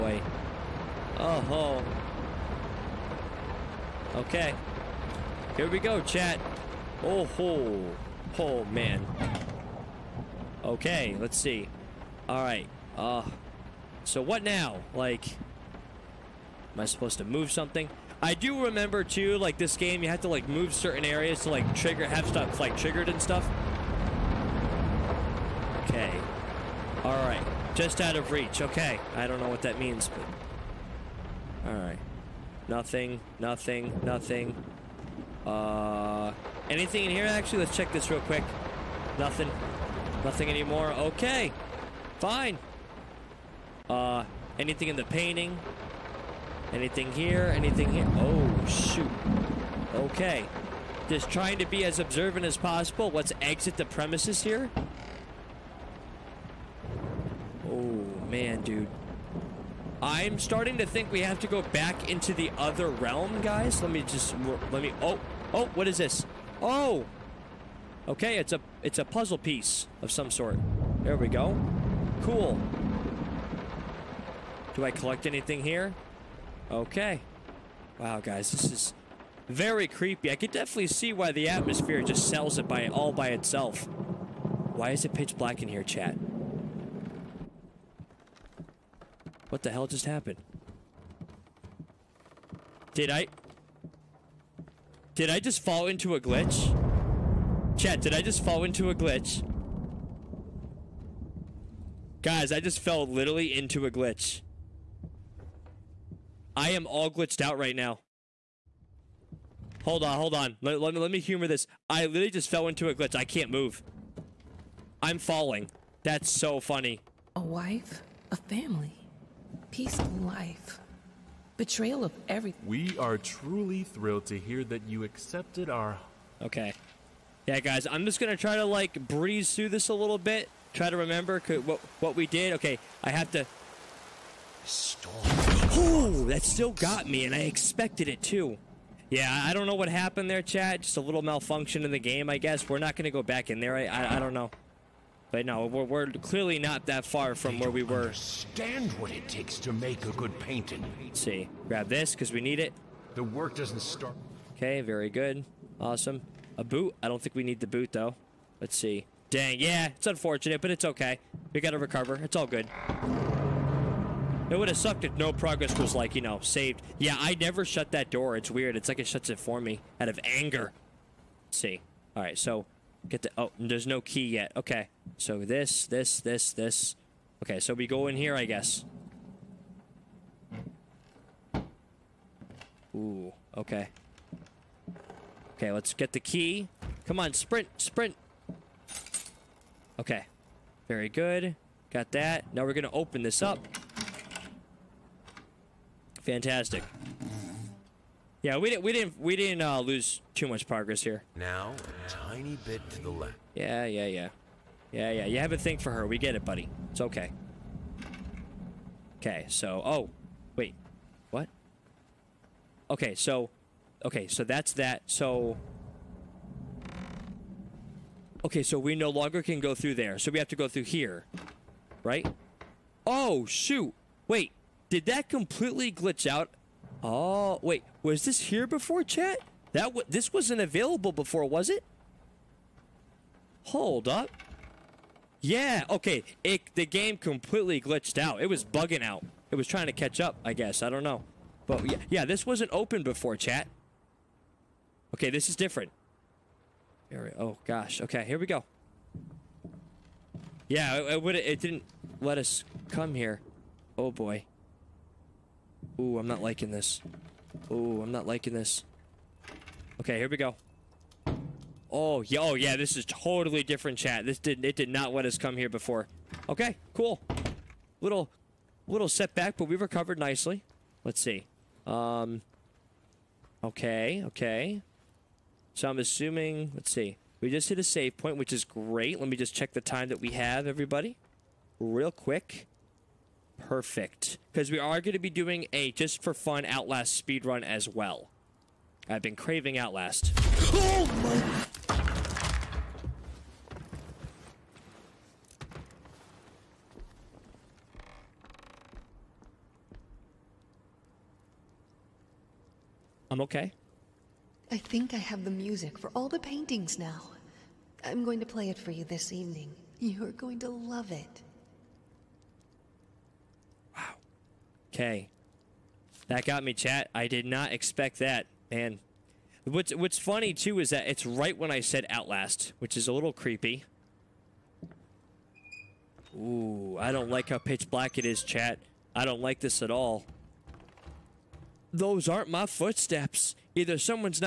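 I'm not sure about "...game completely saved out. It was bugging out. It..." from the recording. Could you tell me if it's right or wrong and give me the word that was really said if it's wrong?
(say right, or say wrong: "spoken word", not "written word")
wrong: "glitched", not "saved".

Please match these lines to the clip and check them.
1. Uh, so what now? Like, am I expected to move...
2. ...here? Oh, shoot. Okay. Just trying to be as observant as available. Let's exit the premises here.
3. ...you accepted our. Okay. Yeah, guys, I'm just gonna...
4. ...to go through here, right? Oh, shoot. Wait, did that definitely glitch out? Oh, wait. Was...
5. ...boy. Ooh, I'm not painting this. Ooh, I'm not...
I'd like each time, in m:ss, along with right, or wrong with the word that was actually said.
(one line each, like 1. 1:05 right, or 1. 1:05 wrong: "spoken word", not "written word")
1. 0:12 wrong: "supposed", not "expected"
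2. 0:47 wrong: "possible", not "available"
3. 2:04 right
4. 3:40 wrong: "completely", not "definitely"
5. 4:14 wrong: "liking", not "painting".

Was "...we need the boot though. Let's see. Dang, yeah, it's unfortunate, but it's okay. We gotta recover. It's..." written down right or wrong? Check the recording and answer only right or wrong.
right.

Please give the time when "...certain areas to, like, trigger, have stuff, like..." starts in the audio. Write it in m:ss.
0:20.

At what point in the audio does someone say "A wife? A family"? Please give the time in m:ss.
1:57.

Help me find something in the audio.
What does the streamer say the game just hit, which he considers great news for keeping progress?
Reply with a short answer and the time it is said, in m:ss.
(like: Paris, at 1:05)
save point, at 4:37.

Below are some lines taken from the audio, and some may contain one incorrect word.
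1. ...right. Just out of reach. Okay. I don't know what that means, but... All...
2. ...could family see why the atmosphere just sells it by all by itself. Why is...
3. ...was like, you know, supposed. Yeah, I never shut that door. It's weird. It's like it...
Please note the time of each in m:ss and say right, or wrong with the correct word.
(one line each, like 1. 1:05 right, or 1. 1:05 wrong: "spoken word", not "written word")
1. 0:27 right
2. 1:20 wrong: "definitely", not "family"
3. 2:45 wrong: "saved", not "supposed".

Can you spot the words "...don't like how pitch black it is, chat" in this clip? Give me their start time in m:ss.
5:27.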